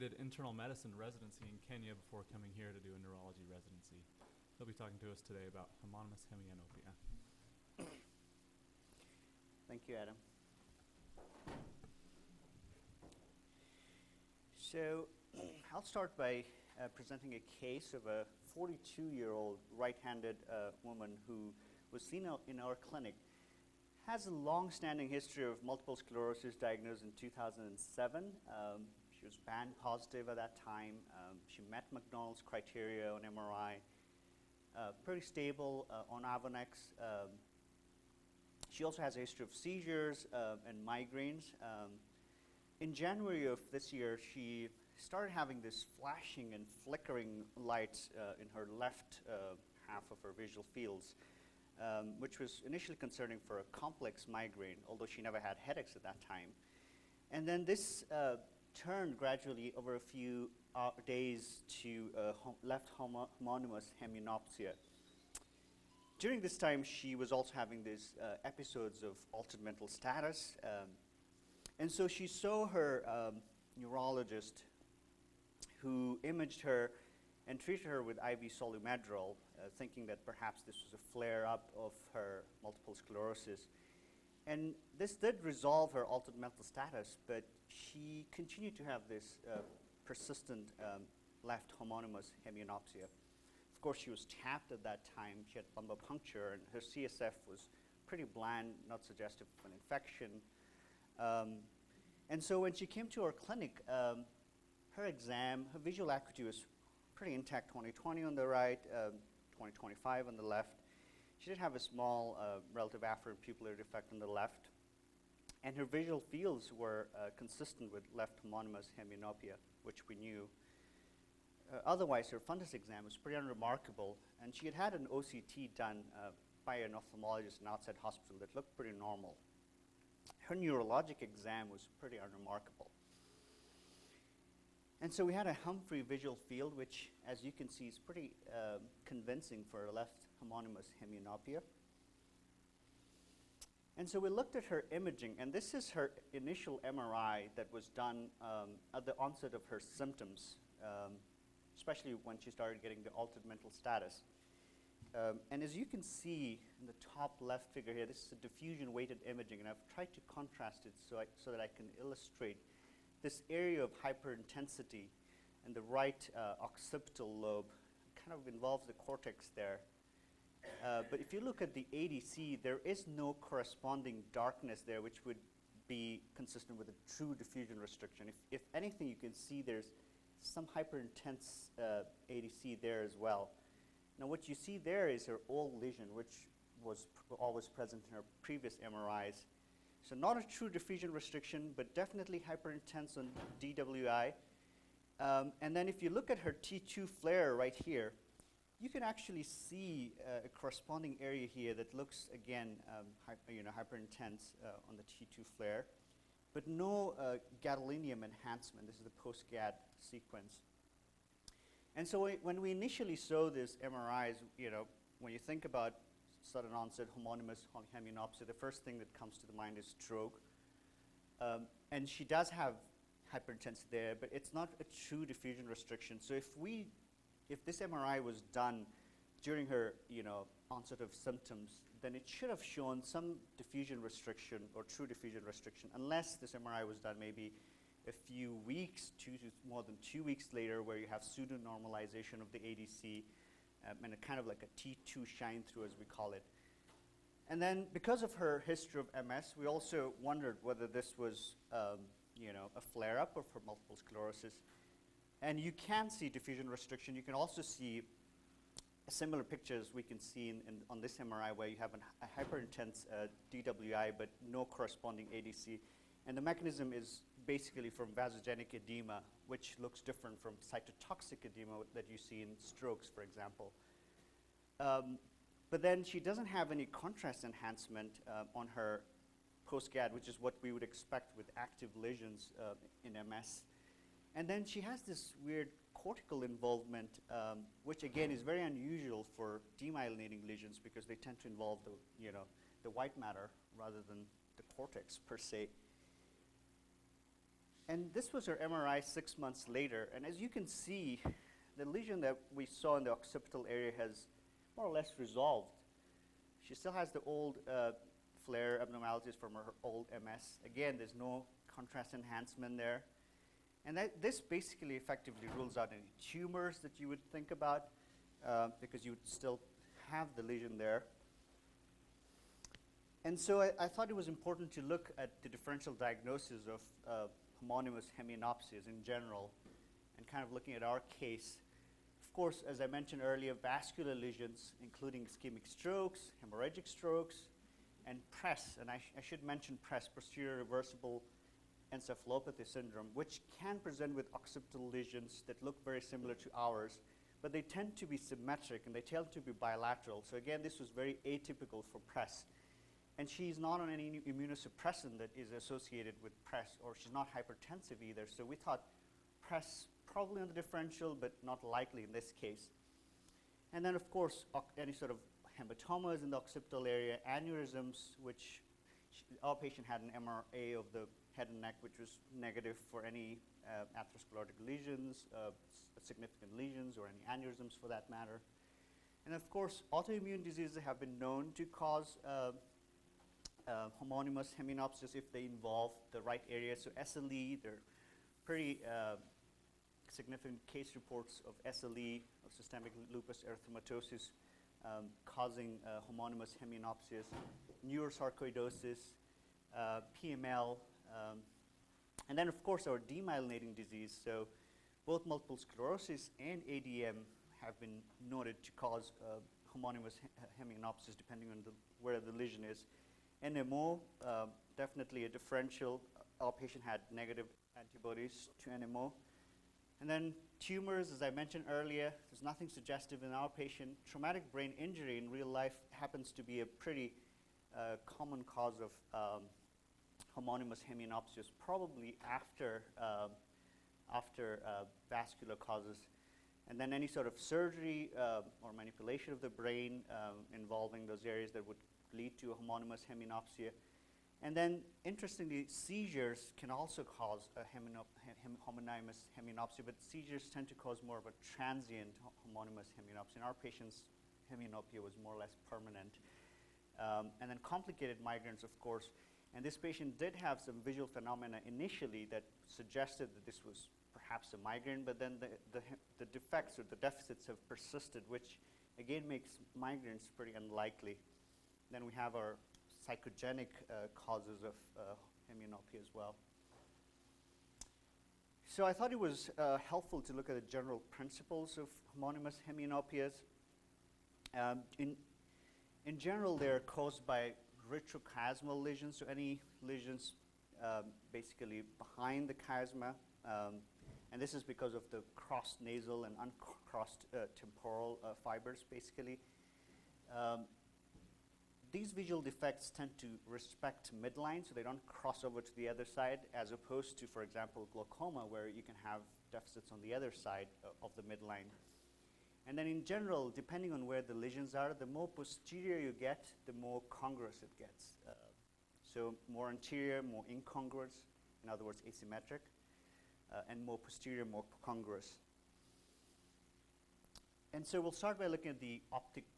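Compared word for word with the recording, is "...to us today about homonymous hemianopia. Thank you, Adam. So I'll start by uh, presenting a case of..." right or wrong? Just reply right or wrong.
right.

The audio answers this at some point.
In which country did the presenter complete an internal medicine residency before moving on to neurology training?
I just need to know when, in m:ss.
0:01.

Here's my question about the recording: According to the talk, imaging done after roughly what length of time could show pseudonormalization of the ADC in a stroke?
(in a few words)
more than 2 weeks.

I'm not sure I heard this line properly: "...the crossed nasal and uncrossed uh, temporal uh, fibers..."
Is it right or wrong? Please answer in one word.
right.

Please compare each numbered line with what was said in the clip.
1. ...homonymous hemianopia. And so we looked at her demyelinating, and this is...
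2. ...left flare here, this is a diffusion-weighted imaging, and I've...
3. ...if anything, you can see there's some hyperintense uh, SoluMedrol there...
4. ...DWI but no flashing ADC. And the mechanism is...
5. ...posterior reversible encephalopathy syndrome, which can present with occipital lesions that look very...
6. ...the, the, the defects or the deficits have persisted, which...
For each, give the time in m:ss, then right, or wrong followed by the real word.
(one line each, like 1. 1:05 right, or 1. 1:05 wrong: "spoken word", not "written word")
1. 2:20 wrong: "imaging", not "demyelinating"
2. 2:37 wrong: "figure", not "flare"
3. 2:58 wrong: "ADC", not "SoluMedrol"
4. 4:23 wrong: "corresponding", not "flashing"
5. 5:40 right
6. 7:45 right.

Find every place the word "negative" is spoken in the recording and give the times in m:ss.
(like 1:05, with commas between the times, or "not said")
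6:12, 6:57.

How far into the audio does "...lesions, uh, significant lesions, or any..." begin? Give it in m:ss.
6:14.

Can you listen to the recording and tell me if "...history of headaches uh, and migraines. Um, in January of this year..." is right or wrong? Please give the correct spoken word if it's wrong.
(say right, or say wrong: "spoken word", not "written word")
wrong: "seizures", not "headaches".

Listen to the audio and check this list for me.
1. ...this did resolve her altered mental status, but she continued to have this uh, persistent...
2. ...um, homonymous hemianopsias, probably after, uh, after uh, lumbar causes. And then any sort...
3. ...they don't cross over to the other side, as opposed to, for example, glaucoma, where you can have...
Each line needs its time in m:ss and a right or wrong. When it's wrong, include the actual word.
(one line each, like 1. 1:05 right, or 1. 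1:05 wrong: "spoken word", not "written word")
1. 1:24 right
2. 7:09 wrong: "vascular", not "lumbar"
3. 8:24 right.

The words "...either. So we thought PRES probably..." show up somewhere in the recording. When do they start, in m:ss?
5:58.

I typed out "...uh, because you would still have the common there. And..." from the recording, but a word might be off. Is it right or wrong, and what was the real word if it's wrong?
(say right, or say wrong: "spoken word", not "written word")
wrong: "lesion", not "common".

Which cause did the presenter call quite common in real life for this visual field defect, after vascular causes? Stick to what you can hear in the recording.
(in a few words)
Traumatic brain injury.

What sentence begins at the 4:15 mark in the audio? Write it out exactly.
And you can see diffusion restriction.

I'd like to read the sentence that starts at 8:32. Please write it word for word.
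And then in general, depending on where the lesions are, the more posterior you get, the more congruous it gets.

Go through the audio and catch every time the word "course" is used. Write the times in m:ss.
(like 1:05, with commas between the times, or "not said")
1:33, 5:32, 6:04, 6:19, 6:42, 7:38.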